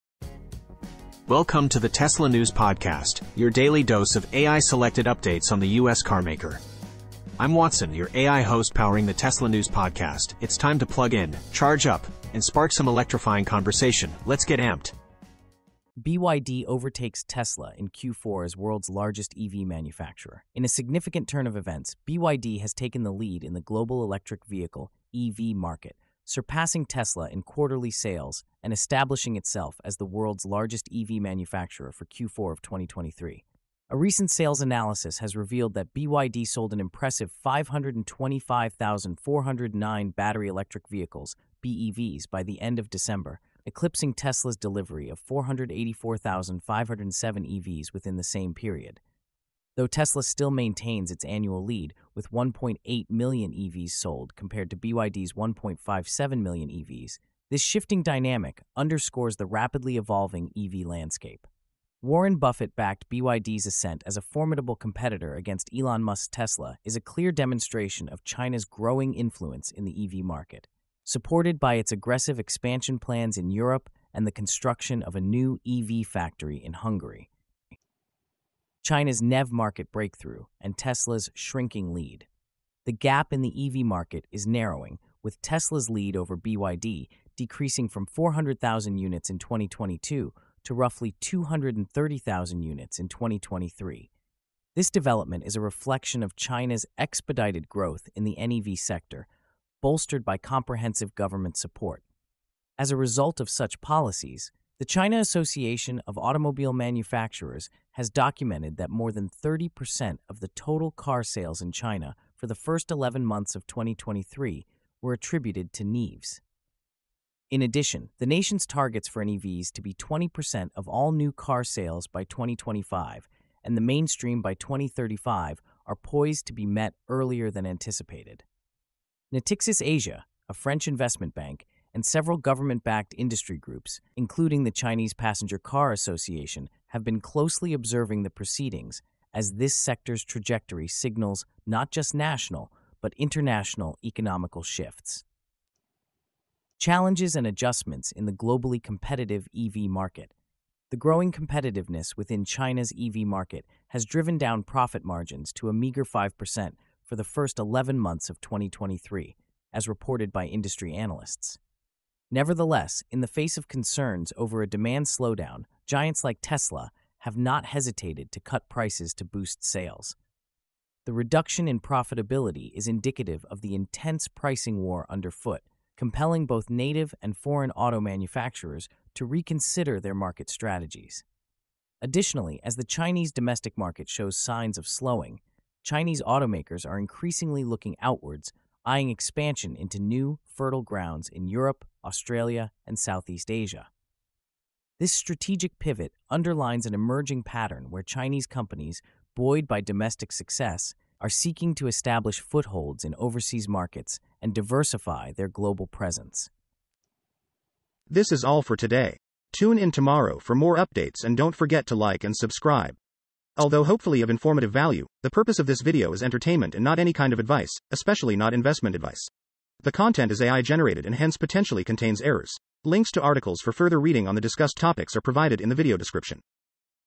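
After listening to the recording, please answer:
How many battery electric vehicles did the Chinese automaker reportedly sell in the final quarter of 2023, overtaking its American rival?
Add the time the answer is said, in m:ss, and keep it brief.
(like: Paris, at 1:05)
525,409, at 0:37.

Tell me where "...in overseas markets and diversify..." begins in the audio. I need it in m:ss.
3:23.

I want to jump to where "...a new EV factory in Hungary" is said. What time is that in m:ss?
1:15.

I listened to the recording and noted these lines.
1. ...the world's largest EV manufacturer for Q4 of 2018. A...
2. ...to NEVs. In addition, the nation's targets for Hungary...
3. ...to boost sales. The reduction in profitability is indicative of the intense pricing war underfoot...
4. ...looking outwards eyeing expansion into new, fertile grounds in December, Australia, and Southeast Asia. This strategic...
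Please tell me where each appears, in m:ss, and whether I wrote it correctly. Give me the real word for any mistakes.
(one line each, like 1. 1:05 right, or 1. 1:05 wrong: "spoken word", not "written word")
1. 0:29 wrong: "2023", not "2018"
2. 1:55 wrong: "NEVs", not "Hungary"
3. 2:49 right
4. 3:07 wrong: "Europe", not "December".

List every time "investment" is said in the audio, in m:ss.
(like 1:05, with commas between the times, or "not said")
2:10, 3:38.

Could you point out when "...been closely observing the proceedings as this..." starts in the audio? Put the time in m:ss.
2:17.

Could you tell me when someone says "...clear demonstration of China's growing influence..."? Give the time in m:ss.
1:07.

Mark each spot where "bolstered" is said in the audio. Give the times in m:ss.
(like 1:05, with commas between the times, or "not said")
1:39.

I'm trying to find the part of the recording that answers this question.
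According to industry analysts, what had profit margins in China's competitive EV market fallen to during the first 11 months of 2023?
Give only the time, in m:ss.
2:36.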